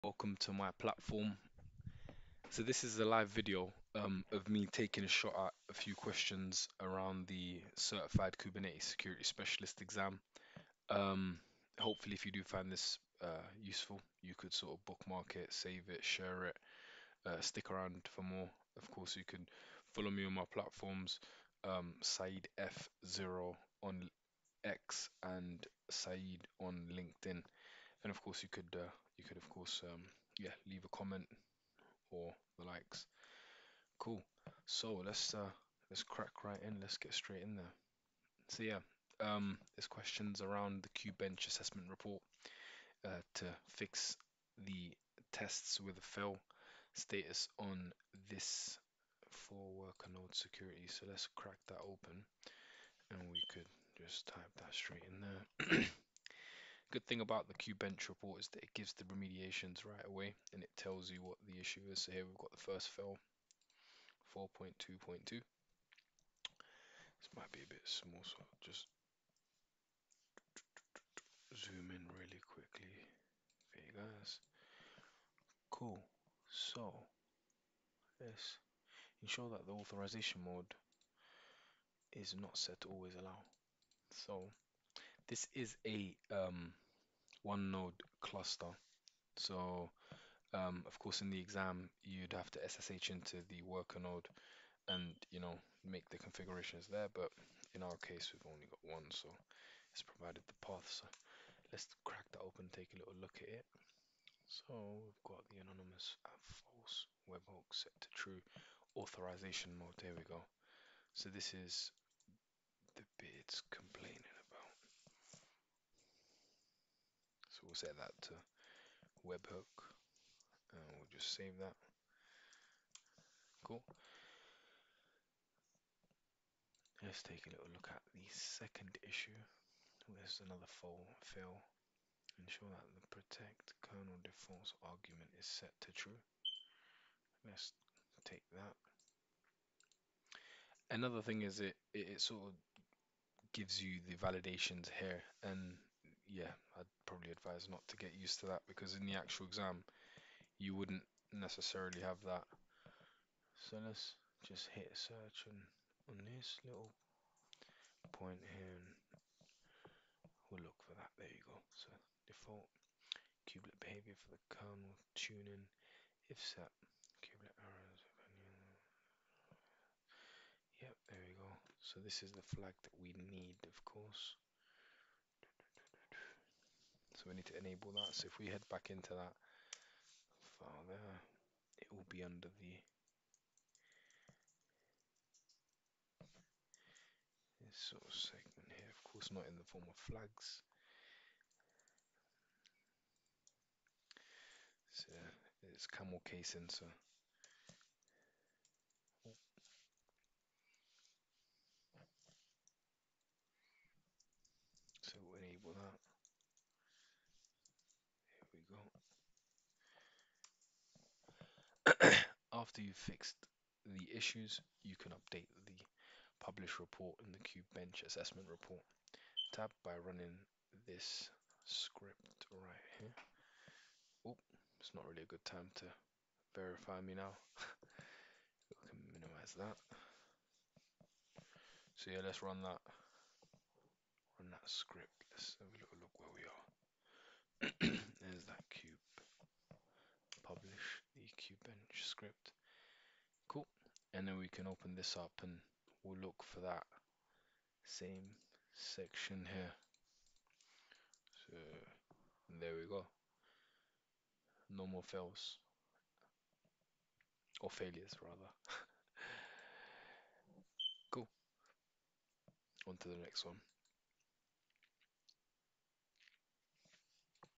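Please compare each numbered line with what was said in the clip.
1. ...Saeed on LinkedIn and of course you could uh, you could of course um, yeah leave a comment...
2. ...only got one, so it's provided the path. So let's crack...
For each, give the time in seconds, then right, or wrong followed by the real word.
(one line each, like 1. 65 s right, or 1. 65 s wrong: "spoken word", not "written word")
1. 25 s right
2. 98 s right.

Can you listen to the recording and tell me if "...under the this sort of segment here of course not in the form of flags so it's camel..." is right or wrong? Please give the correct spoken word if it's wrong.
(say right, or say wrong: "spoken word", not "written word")
right.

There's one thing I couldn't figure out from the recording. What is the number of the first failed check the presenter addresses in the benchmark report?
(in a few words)
4.2.2.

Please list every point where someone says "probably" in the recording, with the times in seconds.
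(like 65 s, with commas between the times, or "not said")
147 s.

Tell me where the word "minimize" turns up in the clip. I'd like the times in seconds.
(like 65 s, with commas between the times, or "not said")
229 s.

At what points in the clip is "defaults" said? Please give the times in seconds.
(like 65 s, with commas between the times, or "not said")
134 s, 162 s.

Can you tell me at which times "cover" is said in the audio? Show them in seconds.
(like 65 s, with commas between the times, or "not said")
not said.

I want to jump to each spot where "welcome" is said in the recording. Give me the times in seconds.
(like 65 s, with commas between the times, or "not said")
0 s.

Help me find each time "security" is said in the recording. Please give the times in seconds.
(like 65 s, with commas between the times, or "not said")
8 s, 50 s.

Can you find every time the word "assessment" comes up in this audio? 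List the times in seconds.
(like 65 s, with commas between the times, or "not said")
41 s, 218 s.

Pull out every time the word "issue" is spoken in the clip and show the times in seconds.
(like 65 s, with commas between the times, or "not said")
61 s, 129 s, 214 s.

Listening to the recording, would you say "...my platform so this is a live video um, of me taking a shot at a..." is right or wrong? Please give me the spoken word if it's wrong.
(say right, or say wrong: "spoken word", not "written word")
right.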